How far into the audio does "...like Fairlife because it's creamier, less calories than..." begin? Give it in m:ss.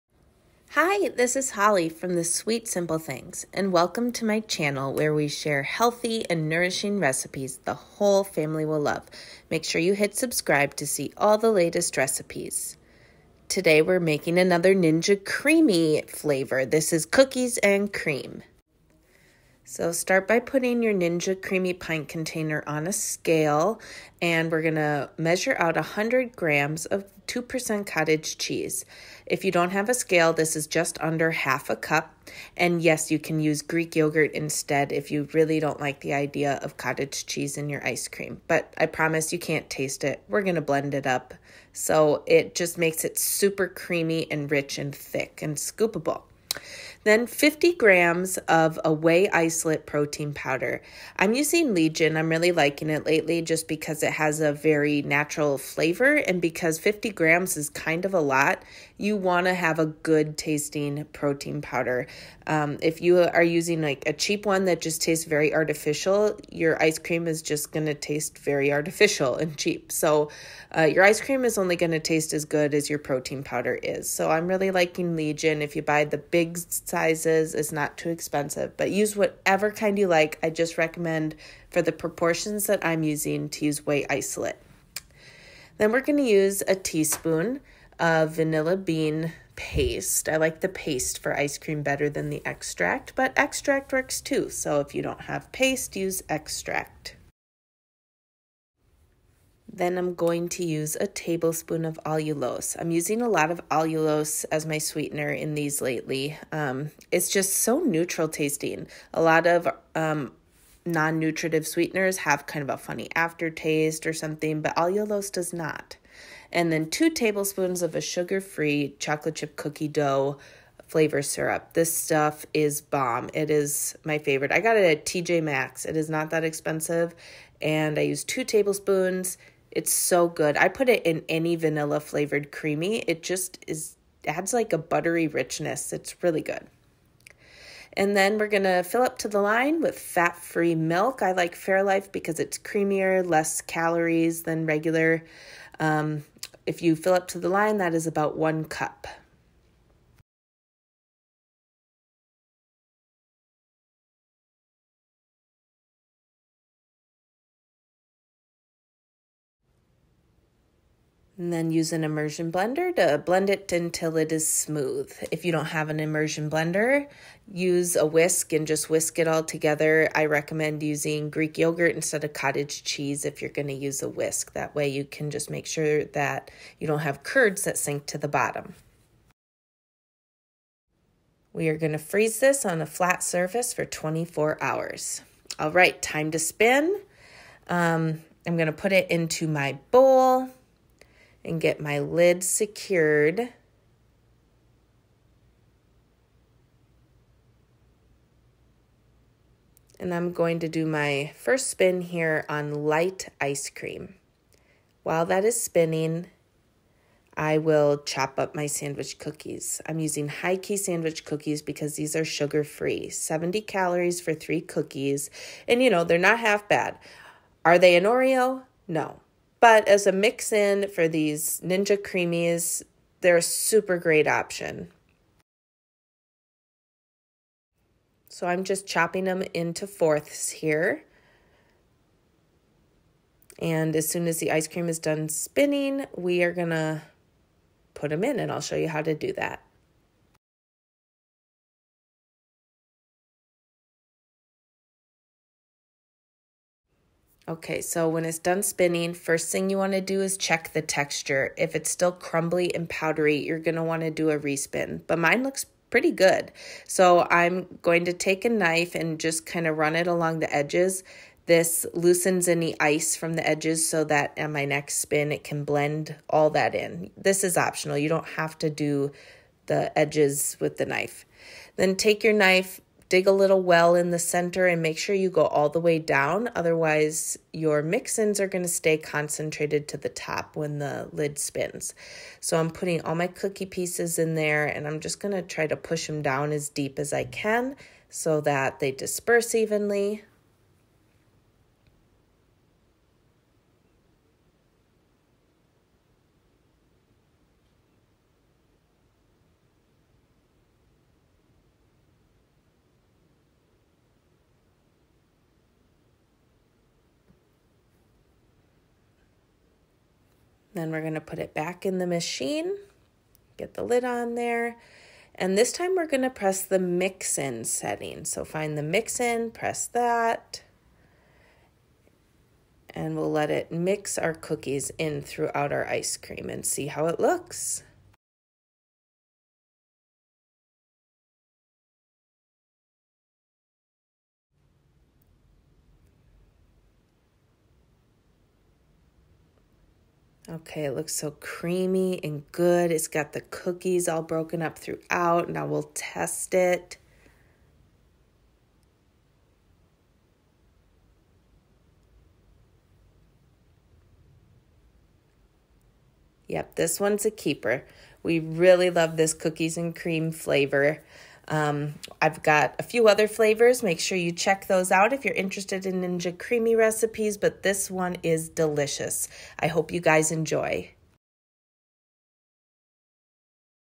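2:21.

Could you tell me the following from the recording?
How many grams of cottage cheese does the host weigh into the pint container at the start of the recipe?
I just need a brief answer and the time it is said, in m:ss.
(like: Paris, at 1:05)
100 grams, at 0:25.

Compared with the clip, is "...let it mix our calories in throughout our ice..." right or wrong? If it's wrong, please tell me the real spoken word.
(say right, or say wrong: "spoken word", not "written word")
wrong: "cookies", not "calories".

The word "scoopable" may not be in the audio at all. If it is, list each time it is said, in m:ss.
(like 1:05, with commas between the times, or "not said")
0:45.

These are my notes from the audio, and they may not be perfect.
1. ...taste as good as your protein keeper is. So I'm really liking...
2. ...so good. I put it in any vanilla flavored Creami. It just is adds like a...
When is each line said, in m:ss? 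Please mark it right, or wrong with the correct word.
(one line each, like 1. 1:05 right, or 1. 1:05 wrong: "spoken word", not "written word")
1. 1:11 wrong: "powder", not "keeper"
2. 2:09 right.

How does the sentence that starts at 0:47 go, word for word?
Then 50 grams of a whey isolate protein powder.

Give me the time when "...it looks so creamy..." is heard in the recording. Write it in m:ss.
5:40.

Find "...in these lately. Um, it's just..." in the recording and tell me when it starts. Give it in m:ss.
1:45.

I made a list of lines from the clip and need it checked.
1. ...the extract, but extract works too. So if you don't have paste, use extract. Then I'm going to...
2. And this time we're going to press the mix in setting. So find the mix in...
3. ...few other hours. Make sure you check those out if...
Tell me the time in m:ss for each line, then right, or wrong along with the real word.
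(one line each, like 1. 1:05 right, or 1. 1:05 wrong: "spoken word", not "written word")
1. 1:32 right
2. 5:15 right
3. 6:02 wrong: "flavors", not "hours".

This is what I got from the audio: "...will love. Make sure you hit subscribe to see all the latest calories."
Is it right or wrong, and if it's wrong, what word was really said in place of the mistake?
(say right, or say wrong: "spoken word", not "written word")
wrong: "recipes", not "calories".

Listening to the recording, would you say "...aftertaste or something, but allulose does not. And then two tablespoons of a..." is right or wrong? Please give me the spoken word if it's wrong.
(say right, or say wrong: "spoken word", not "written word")
right.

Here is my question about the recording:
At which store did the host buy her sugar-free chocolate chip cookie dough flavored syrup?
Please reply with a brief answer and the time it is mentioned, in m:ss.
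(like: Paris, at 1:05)
TJ Maxx, at 2:05.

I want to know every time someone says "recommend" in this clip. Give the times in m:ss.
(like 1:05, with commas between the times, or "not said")
1:20, 2:50.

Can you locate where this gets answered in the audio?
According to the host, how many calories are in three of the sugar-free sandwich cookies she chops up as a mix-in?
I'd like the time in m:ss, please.
3:33.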